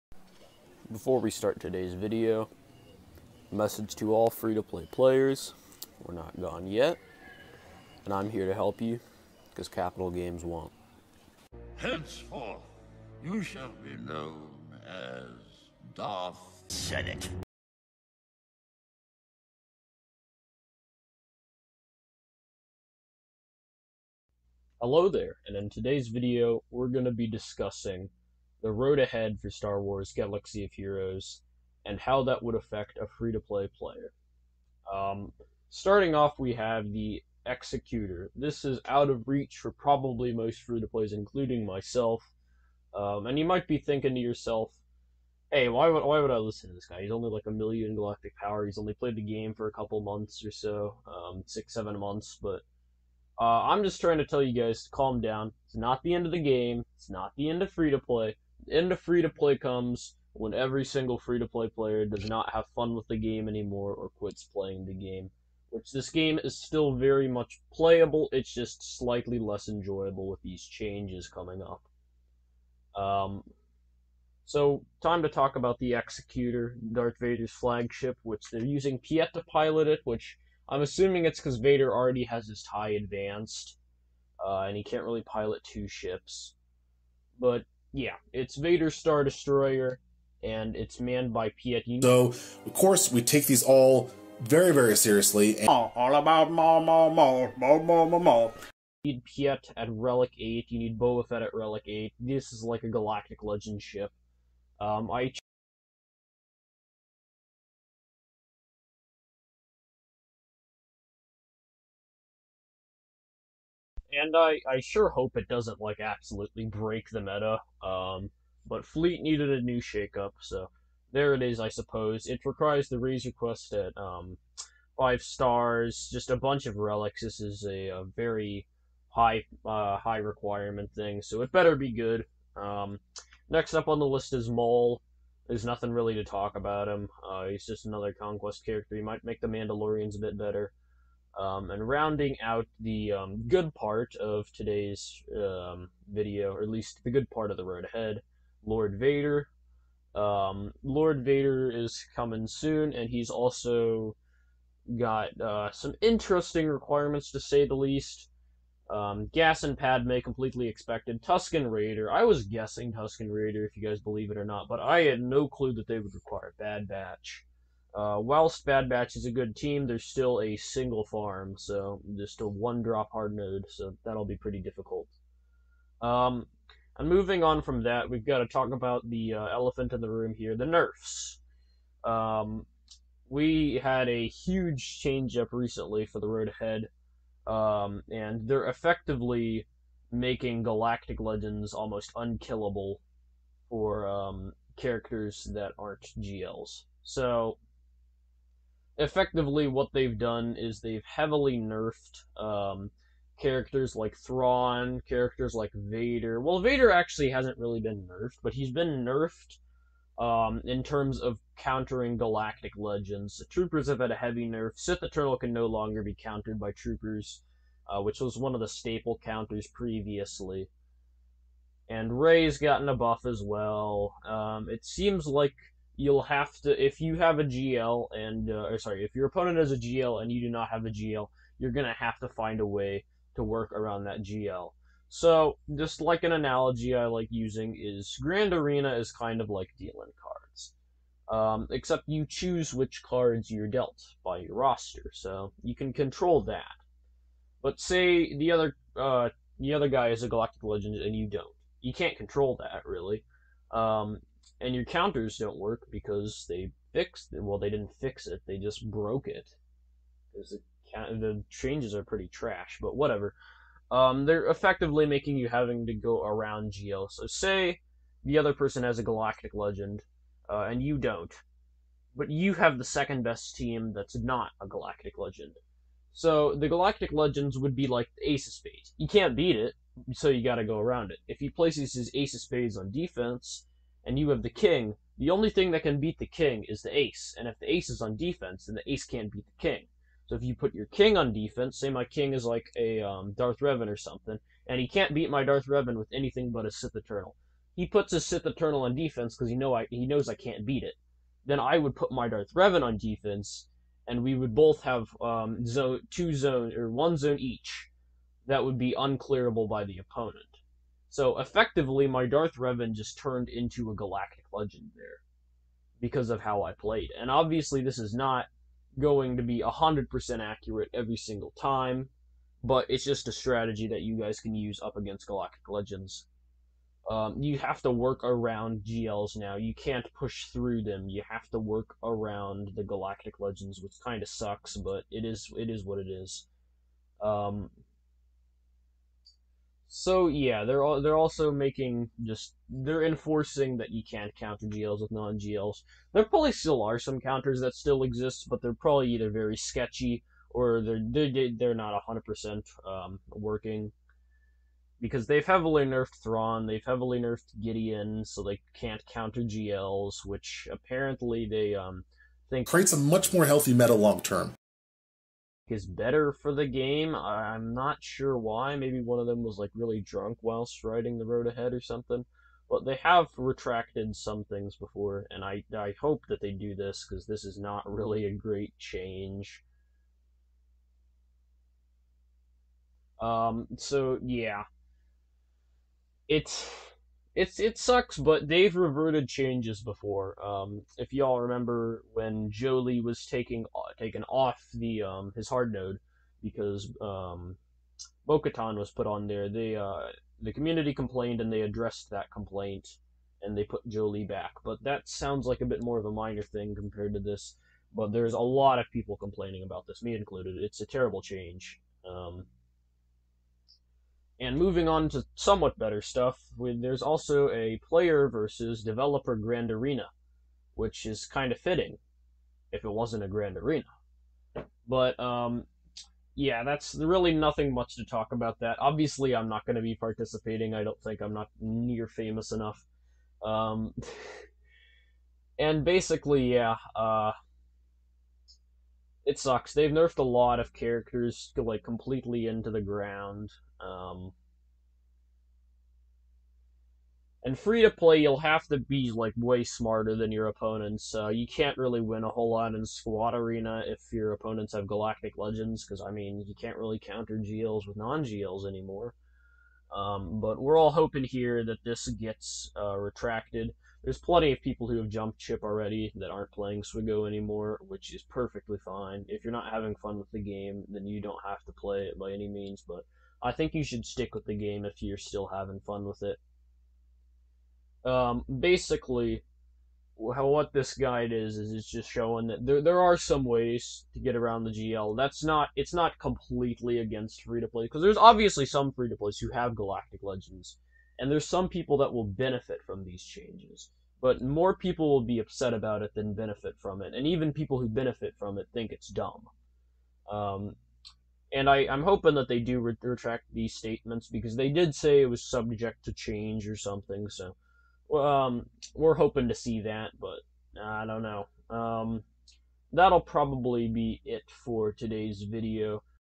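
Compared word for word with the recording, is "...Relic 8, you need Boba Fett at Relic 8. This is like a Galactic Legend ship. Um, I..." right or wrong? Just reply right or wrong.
right.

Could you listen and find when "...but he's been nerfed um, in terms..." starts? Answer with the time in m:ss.
3:28.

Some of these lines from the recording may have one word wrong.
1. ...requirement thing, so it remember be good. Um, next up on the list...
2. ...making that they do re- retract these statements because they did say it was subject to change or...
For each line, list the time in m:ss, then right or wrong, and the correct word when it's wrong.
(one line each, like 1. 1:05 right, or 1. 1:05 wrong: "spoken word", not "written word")
1. 2:10 wrong: "better", not "remember"
2. 8:22 wrong: "hoping", not "making".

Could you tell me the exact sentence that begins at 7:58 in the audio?
Um, basically, how, what this guide is is it's just showing that there there are some ways to get around the GL.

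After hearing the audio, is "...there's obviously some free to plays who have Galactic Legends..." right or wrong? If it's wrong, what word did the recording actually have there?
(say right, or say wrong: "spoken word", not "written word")
right.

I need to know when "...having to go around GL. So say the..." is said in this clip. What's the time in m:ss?
4:25.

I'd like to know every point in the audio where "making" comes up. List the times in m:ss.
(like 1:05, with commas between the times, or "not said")
3:10, 4:25, 5:41.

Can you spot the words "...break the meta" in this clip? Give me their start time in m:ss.
1:56.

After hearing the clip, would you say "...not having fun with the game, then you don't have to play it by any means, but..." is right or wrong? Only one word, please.
right.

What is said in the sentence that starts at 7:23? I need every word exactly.
Um, and free to play, you'll have to be like way smarter than your opponents.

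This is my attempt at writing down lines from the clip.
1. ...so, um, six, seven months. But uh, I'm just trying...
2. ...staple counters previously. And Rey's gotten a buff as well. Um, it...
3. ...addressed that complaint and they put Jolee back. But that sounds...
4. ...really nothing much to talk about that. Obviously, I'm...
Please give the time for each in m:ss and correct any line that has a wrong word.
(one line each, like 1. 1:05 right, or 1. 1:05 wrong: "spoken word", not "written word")
1. 0:50 right
2. 3:38 right
3. 6:41 right
4. 7:06 right.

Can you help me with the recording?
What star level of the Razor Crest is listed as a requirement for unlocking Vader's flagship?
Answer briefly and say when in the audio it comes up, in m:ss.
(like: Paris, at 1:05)
5 stars, at 2:04.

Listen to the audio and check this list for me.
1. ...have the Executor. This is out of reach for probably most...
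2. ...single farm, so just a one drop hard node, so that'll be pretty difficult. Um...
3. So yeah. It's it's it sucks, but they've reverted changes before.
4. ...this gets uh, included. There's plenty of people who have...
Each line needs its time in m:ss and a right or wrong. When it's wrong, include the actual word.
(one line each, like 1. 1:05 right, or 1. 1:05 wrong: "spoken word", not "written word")
1. 0:36 right
2. 2:50 right
3. 6:23 right
4. 7:41 wrong: "retracted", not "included".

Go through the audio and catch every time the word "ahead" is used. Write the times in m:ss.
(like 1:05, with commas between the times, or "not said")
0:28, 2:27, 3:06, 6:11.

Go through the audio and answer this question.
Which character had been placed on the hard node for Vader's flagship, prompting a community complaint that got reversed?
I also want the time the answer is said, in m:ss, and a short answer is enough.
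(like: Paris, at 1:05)
Bo-Katan, at 6:38.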